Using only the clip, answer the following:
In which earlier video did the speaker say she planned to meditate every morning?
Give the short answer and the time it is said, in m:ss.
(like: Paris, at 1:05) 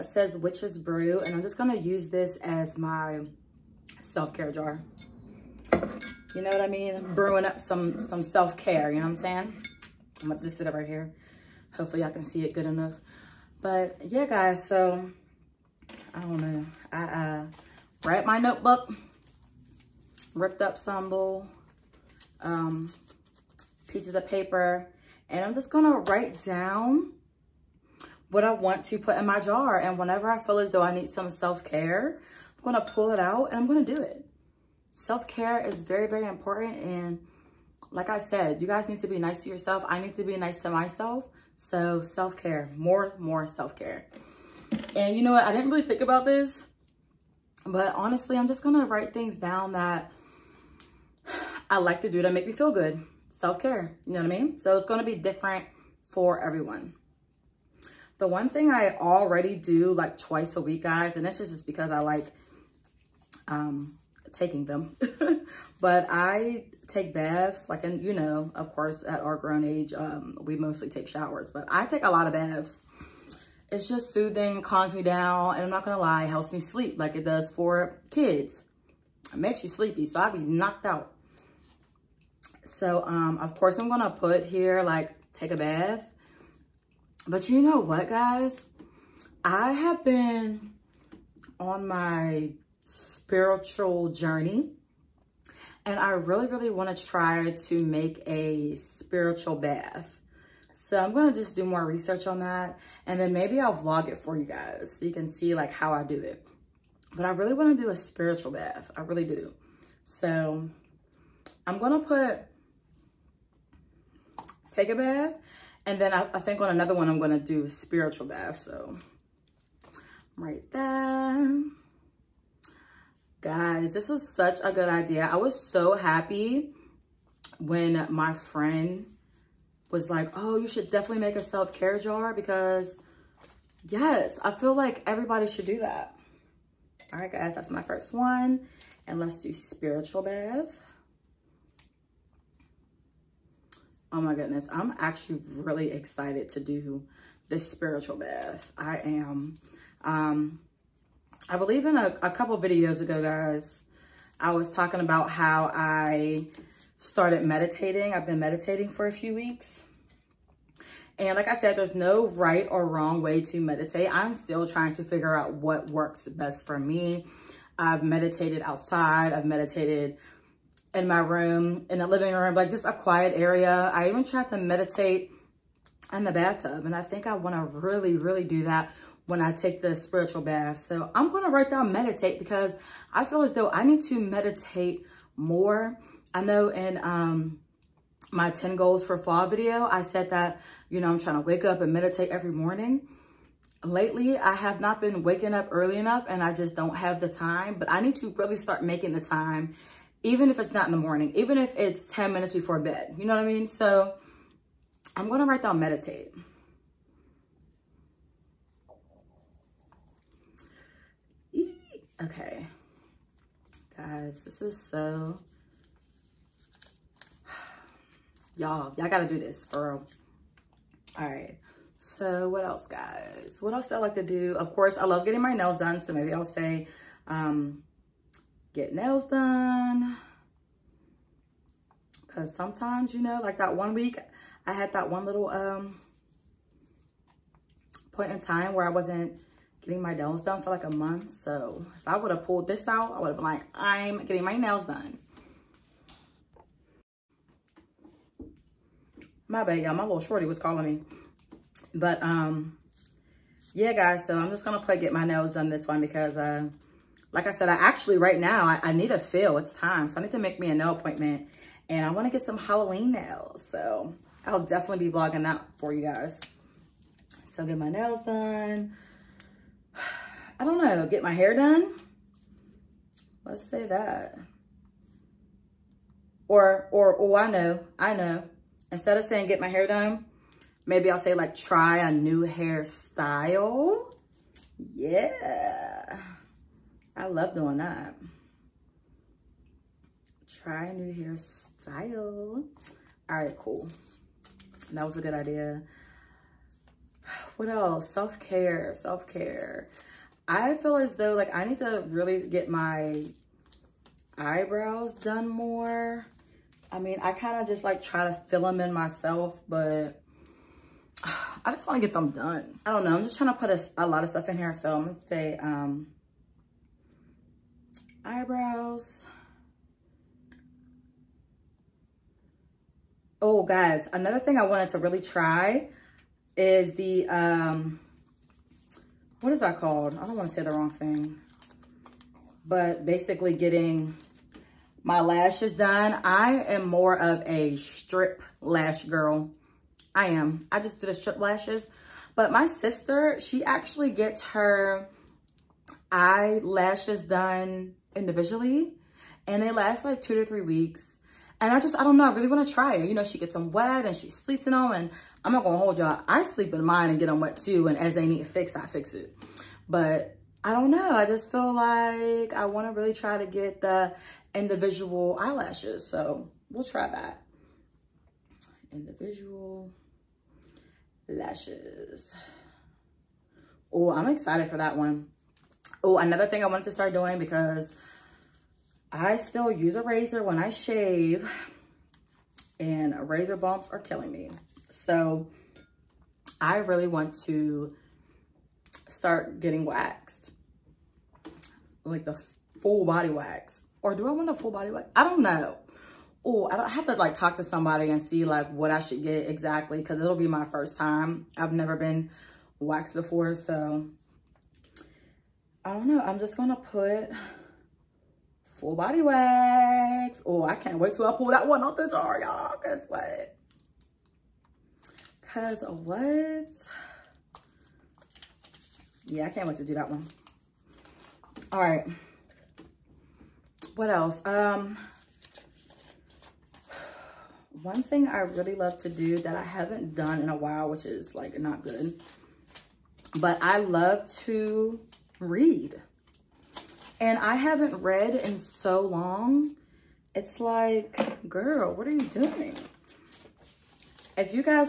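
10 goals for fall, at 3:08.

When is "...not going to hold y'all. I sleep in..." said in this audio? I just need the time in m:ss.
5:55.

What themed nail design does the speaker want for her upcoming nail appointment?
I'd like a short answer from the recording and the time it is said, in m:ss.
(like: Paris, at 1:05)
Halloween nails, at 4:22.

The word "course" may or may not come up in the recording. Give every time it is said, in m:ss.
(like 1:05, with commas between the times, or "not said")
1:08, 1:23, 3:44.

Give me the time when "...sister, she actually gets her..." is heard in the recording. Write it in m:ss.
5:42.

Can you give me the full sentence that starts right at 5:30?
I don't want to say the wrong thing.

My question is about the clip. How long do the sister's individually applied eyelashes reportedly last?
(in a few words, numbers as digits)
2 to 3 weeks.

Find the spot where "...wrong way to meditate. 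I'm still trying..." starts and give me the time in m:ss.
2:42.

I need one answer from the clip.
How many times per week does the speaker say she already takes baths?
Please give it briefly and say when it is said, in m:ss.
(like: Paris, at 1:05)
Twice, at 1:00.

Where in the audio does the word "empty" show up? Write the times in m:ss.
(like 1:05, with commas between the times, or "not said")
not said.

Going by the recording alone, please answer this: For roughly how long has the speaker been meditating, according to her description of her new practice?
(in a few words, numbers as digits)
A few weeks.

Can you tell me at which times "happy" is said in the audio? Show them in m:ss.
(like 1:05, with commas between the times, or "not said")
2:05.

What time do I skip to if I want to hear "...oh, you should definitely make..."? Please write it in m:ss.
2:10.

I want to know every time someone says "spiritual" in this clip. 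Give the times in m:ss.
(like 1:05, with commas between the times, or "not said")
1:32, 1:38, 1:47, 1:57, 2:19, 2:27, 2:59.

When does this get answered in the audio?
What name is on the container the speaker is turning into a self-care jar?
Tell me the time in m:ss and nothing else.
0:00.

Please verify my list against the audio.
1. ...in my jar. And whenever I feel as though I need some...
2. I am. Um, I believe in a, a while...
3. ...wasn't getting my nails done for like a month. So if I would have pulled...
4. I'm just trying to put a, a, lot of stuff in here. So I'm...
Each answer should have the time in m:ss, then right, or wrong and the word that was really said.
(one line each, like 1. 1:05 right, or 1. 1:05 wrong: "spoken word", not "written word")
1. 0:29 right
2. 2:28 wrong: "couple", not "while"
3. 3:58 right
4. 5:13 right.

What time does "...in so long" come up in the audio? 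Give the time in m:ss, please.
7:18.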